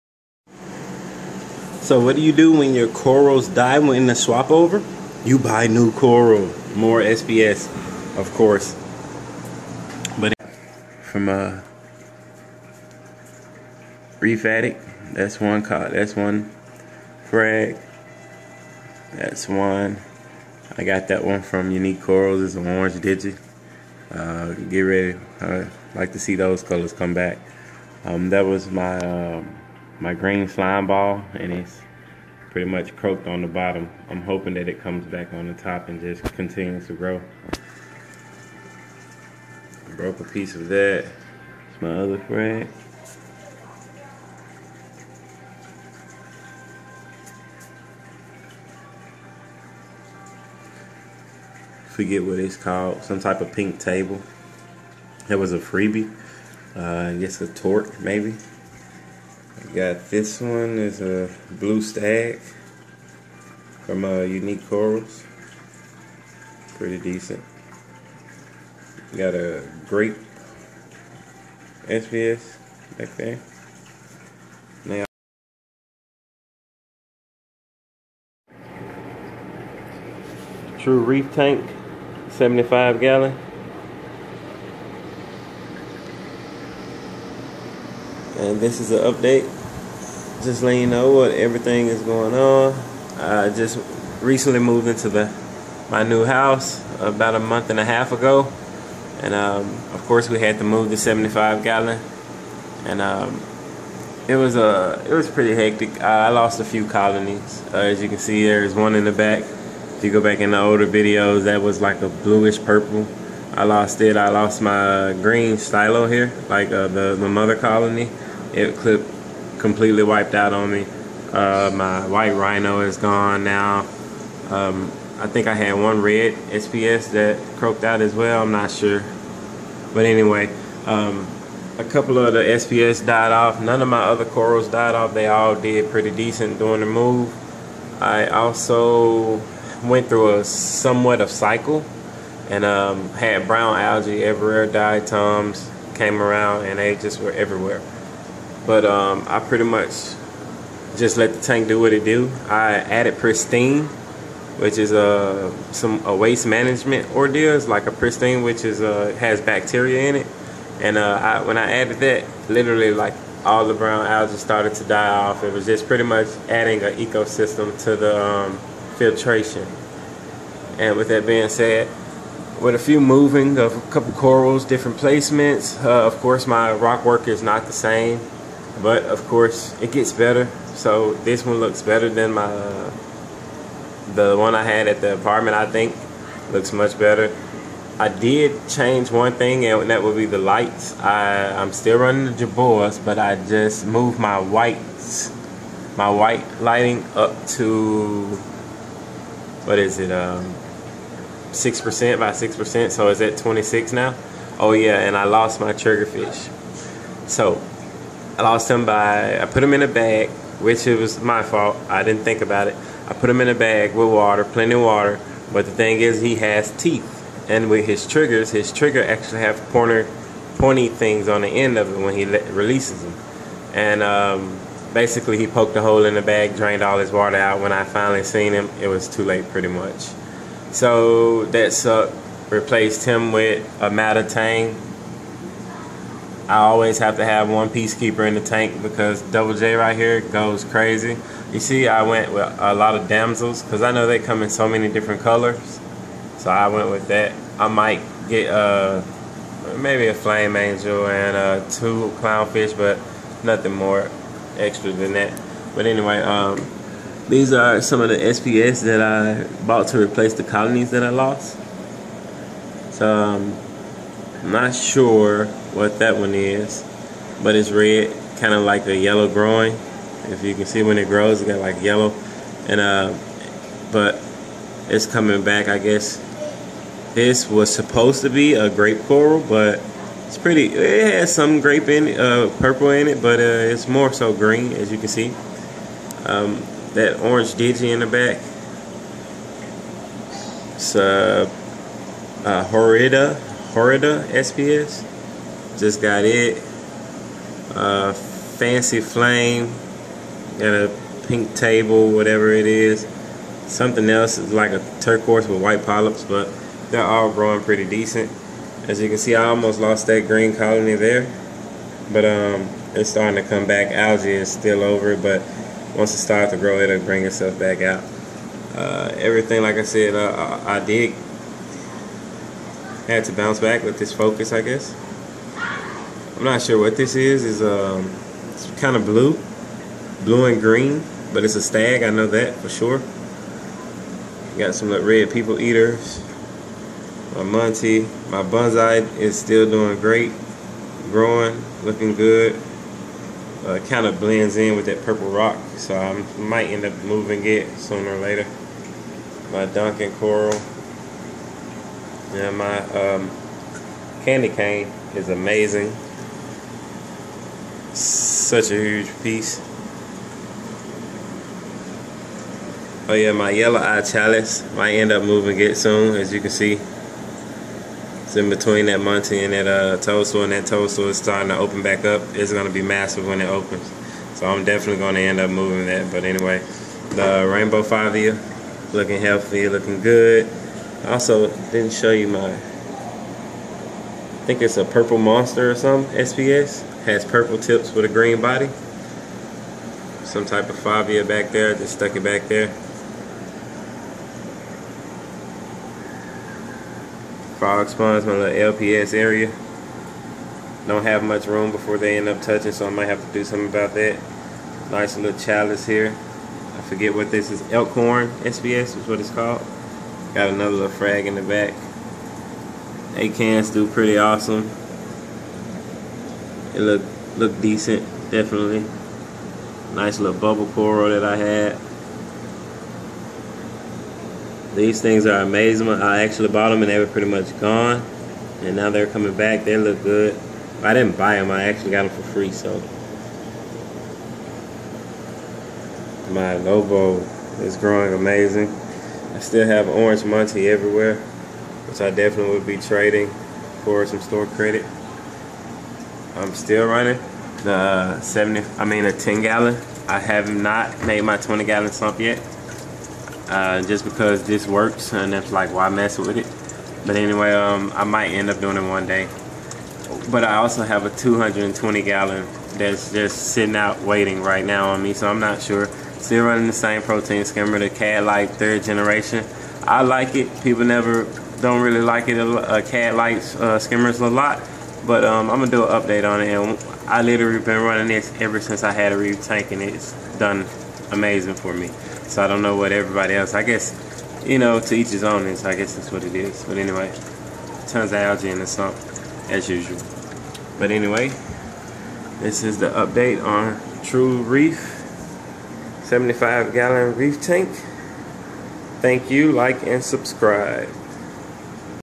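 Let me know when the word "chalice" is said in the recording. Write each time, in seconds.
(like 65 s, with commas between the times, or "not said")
364 s, 405 s.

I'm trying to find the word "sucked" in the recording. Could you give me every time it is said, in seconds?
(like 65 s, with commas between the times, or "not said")
231 s.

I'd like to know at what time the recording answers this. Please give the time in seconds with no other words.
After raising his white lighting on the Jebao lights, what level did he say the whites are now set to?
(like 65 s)
203 s.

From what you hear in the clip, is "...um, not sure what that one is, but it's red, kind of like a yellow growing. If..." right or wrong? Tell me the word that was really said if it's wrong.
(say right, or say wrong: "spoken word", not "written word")
right.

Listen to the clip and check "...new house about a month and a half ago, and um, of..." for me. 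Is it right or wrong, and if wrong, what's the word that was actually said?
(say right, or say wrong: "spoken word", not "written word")
right.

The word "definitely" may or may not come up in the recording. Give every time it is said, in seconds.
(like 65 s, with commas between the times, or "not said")
374 s, 418 s, 442 s.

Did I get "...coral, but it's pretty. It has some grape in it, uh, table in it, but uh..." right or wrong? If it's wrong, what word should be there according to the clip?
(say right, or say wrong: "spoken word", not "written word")
wrong: "purple", not "table".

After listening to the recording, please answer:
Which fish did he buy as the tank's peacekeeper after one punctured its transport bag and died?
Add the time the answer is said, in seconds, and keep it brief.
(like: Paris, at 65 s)
Matatang, at 233 s.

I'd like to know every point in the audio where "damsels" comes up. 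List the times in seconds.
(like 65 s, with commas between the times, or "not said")
243 s.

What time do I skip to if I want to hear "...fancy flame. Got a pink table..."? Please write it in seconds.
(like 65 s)
298 s.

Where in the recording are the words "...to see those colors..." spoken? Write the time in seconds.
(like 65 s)
26 s.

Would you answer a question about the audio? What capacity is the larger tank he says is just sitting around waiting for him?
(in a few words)
220 gallon.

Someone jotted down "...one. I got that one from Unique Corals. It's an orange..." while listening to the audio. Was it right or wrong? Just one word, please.
right.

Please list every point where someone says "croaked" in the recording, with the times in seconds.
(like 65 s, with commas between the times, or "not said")
32 s, 127 s.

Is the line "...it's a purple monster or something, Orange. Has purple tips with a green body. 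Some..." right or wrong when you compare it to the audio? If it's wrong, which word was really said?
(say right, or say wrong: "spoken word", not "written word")
wrong: "SPS", not "Orange".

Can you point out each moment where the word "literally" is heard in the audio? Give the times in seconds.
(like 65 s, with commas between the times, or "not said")
162 s, 477 s.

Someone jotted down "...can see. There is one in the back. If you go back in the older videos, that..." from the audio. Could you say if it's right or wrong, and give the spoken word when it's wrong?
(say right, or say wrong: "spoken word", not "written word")
right.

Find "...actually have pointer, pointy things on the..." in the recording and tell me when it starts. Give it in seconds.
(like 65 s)
219 s.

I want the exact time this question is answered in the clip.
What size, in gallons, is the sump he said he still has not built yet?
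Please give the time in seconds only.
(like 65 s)
451 s.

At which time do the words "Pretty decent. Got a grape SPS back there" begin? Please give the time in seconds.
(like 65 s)
66 s.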